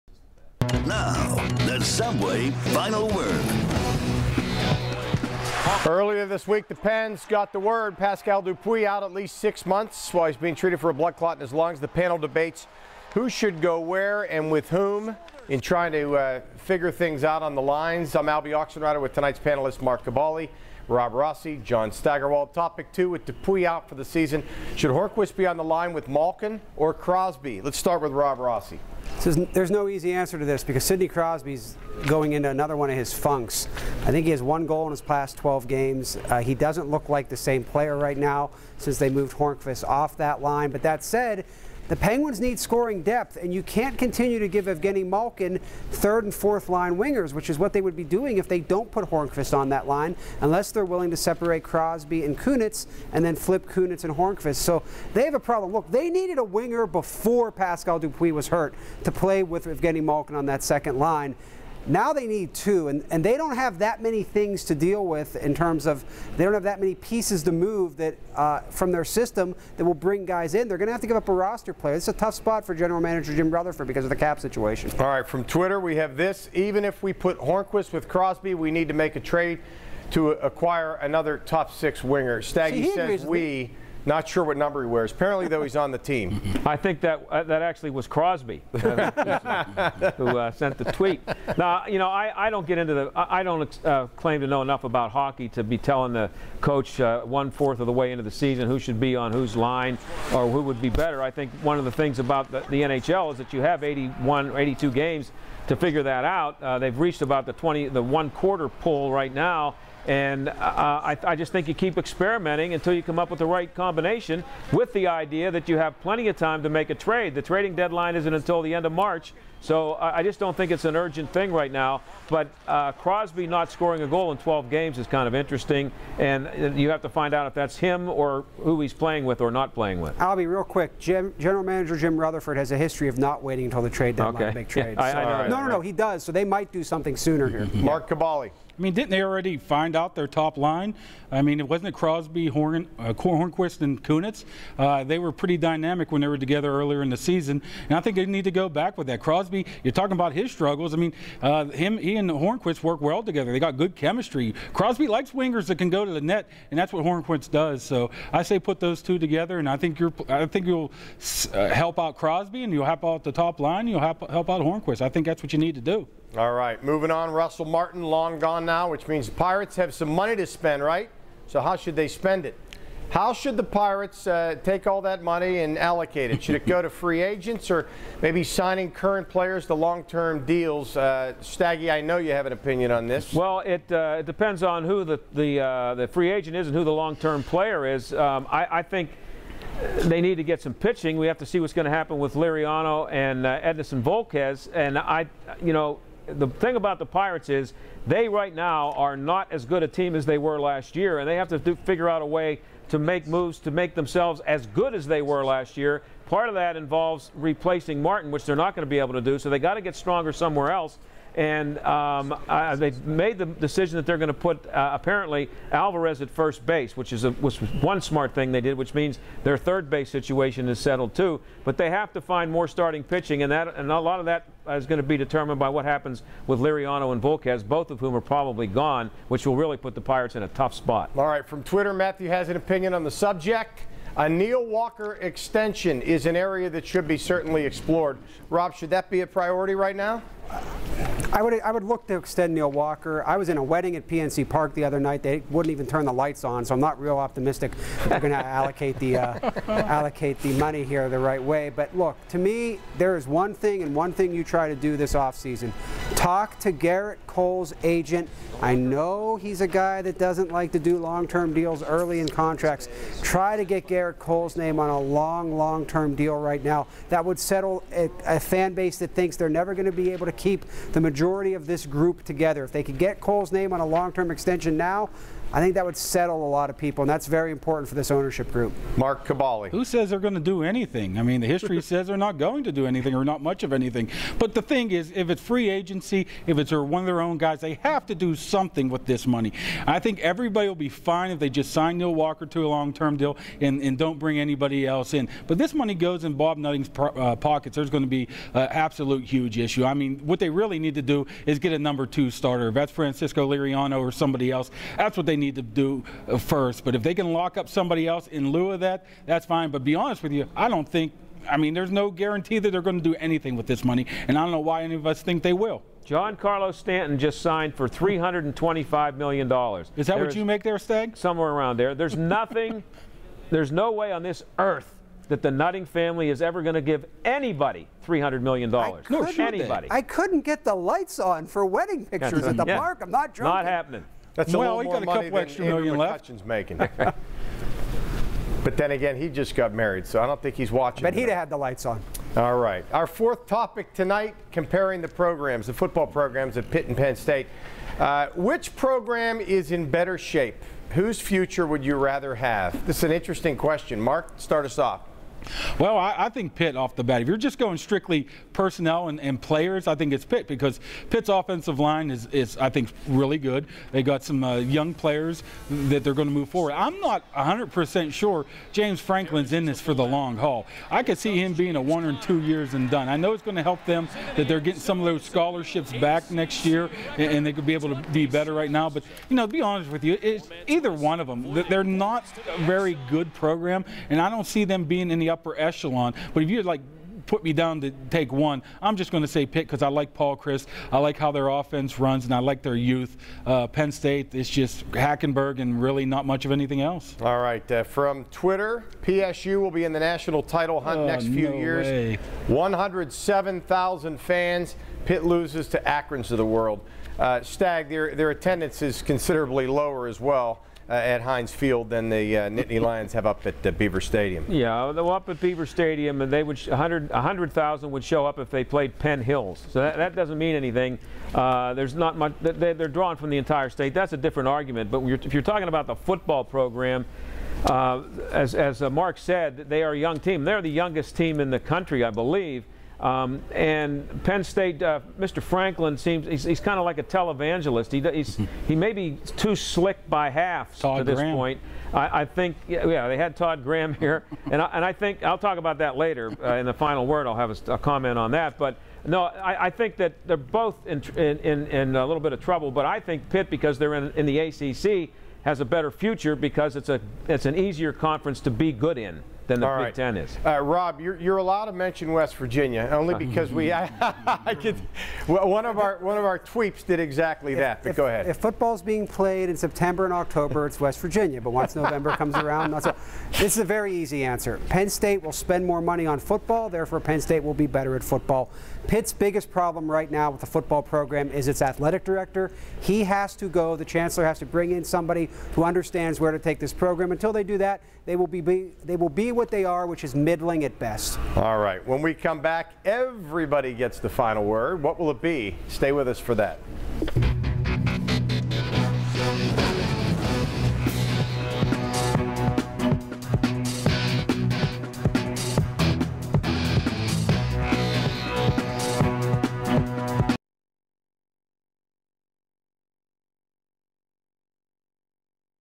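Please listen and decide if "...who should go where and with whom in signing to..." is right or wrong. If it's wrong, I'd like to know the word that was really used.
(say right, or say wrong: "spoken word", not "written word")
wrong: "trying", not "signing".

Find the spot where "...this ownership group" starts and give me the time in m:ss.
4:37.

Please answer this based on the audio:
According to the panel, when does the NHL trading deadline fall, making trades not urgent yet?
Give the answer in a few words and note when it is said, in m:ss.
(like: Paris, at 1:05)
end of March, at 1:58.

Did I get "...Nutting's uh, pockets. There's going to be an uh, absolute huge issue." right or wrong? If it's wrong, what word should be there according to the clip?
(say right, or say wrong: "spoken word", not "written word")
right.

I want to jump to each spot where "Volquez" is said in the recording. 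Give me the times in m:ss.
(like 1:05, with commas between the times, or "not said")
3:14, 3:47.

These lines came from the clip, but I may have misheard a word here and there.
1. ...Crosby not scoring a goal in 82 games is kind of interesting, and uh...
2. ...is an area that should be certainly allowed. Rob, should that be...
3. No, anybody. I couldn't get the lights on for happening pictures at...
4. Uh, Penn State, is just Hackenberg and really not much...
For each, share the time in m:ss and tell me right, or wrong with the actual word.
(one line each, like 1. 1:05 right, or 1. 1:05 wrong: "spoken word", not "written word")
1. 2:02 wrong: "12", not "82"
2. 3:56 wrong: "explored", not "allowed"
3. 5:28 wrong: "wedding", not "happening"
4. 6:33 right.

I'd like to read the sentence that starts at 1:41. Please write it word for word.
I think one of the things about the, the NHL is that you have 81, 82 games to figure that out.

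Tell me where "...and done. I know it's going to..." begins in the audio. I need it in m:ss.
6:12.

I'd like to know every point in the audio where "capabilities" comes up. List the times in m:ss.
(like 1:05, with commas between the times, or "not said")
not said.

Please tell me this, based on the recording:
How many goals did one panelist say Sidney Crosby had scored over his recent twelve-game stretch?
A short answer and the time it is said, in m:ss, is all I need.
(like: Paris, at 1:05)
1, at 0:34.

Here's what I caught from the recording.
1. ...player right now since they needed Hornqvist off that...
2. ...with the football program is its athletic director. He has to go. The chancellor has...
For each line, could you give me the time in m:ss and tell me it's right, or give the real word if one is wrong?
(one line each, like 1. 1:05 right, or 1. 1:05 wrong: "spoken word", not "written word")
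1. 0:37 wrong: "moved", not "needed"
2. 8:00 right.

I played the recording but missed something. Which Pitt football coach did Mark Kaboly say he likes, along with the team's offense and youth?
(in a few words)
Paul Chryst.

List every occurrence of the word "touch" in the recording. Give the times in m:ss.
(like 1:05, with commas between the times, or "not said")
not said.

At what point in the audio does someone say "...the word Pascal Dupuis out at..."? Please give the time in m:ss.
0:07.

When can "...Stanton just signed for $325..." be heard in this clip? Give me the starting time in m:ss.
5:16.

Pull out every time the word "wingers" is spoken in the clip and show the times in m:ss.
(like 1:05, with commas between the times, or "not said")
0:46, 0:56, 1:22, 2:35.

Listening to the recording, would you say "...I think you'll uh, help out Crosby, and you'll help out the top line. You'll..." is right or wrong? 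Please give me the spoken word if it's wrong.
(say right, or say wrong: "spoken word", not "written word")
right.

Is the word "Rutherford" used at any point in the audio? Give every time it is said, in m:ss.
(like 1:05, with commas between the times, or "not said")
1:13, 2:12.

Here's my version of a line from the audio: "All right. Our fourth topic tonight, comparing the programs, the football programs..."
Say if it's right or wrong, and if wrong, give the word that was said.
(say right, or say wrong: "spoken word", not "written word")
right.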